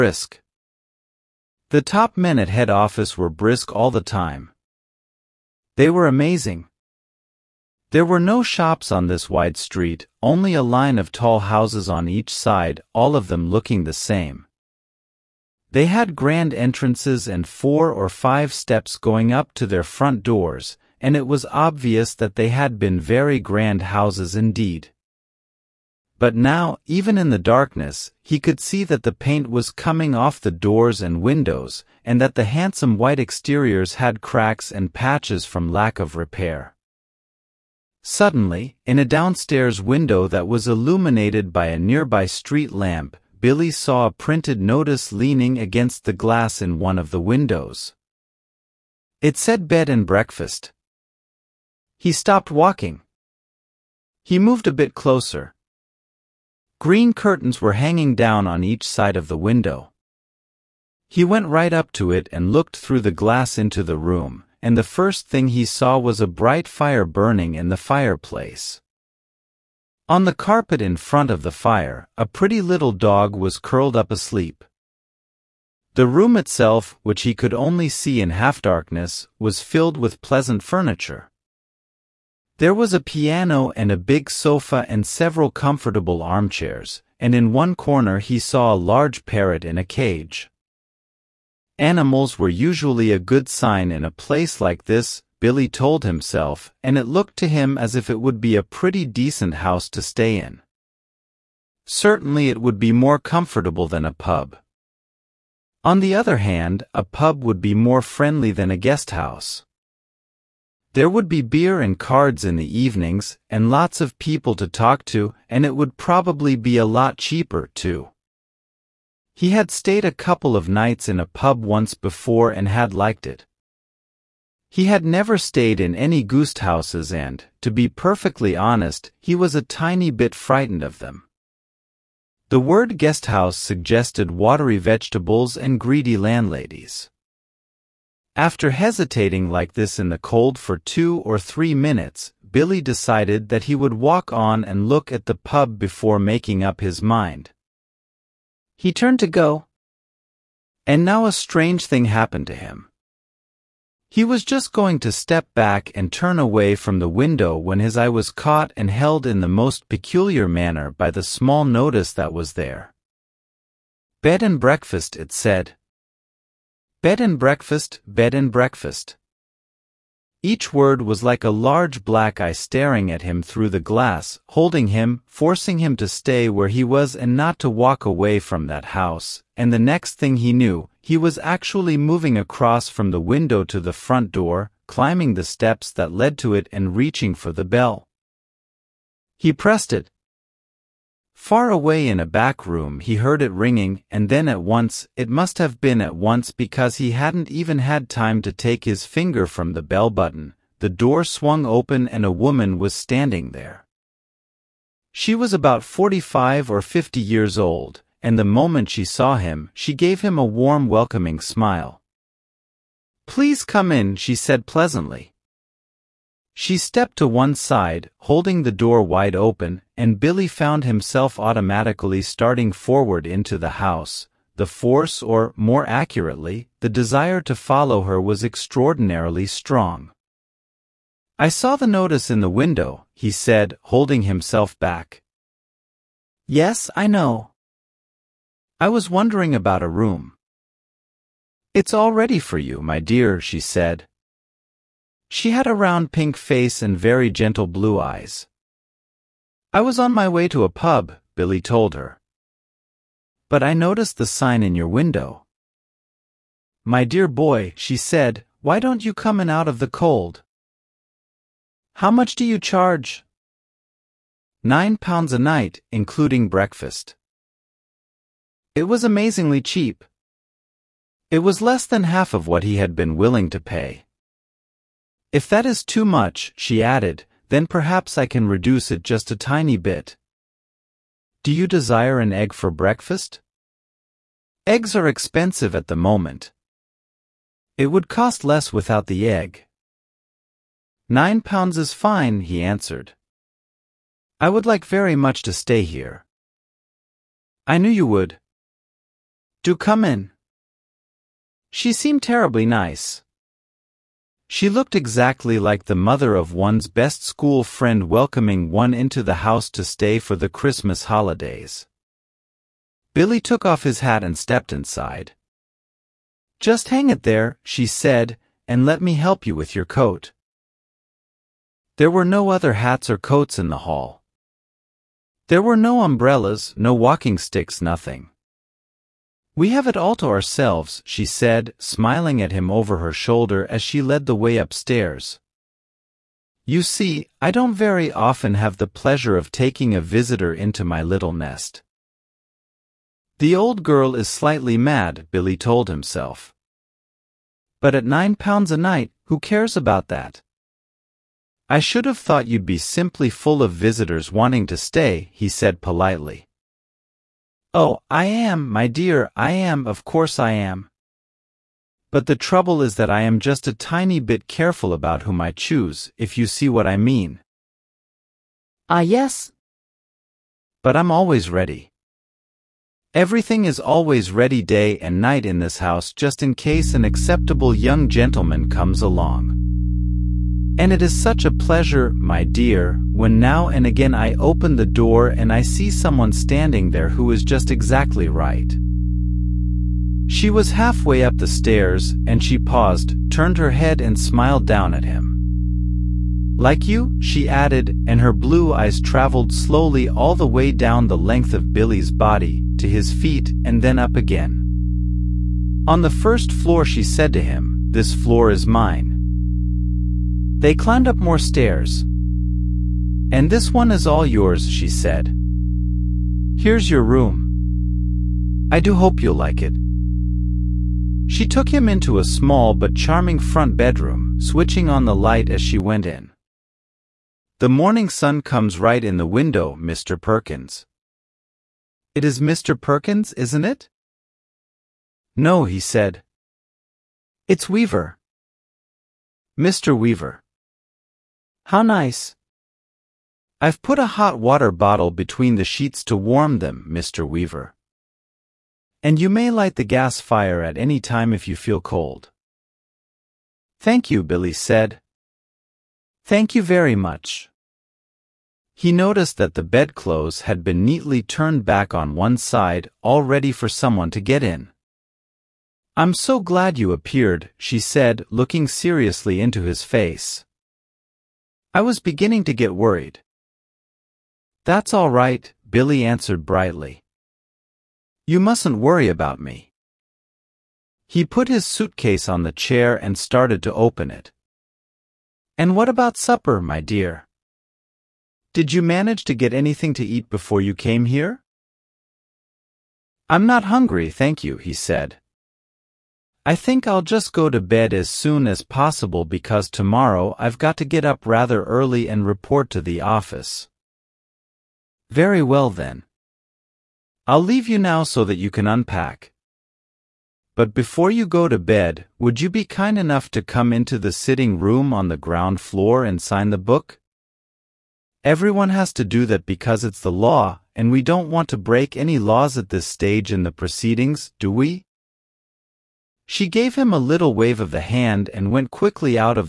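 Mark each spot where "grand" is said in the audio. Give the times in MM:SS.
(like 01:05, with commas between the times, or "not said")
00:16, 00:23.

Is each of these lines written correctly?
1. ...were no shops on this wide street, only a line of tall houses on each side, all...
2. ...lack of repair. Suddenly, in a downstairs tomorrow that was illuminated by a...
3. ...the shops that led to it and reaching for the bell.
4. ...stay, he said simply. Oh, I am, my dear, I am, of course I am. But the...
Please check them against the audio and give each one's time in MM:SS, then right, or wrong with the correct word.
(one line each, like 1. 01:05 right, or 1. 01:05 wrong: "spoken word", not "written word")
1. 00:08 right
2. 00:35 wrong: "window", not "tomorrow"
3. 03:05 wrong: "steps", not "shops"
4. 05:54 wrong: "politely", not "simply".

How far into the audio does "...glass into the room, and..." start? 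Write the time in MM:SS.
01:03.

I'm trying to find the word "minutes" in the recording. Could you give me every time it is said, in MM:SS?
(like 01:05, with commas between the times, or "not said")
02:21.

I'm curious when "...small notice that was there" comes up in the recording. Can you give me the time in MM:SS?
02:41.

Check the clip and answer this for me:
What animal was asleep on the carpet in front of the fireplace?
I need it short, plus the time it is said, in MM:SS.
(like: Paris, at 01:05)
Dog, at 01:12.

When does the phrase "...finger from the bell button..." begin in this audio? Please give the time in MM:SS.
03:19.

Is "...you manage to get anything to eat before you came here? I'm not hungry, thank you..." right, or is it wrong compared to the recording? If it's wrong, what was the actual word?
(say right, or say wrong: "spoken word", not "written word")
right.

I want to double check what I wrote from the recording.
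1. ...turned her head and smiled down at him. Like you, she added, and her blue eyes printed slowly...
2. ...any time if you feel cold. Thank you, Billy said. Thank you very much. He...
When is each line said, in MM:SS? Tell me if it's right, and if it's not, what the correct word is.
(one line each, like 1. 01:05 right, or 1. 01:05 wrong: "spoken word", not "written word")
1. 06:33 wrong: "traveled", not "printed"
2. 07:30 right.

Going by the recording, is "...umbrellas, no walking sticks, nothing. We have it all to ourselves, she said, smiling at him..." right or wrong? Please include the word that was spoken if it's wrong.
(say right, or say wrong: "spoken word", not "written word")
right.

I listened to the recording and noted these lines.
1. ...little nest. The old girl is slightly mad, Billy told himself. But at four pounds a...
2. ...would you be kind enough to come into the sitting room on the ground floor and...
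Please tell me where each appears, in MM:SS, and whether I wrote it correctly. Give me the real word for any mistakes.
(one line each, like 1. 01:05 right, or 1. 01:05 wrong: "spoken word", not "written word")
1. 05:41 wrong: "nine", not "four"
2. 08:32 right.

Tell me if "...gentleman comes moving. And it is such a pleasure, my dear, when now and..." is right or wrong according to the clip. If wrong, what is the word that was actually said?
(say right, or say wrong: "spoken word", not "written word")
wrong: "along", not "moving".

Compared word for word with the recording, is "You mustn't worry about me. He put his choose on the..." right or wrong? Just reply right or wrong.
wrong.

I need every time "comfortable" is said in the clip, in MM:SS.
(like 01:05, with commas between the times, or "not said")
01:25, 01:43.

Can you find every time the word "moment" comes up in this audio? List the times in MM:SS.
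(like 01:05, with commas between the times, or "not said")
03:28, 04:45.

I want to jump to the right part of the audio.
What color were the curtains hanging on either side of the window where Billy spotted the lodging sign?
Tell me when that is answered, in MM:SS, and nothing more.
00:56.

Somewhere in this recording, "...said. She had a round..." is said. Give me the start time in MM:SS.
04:03.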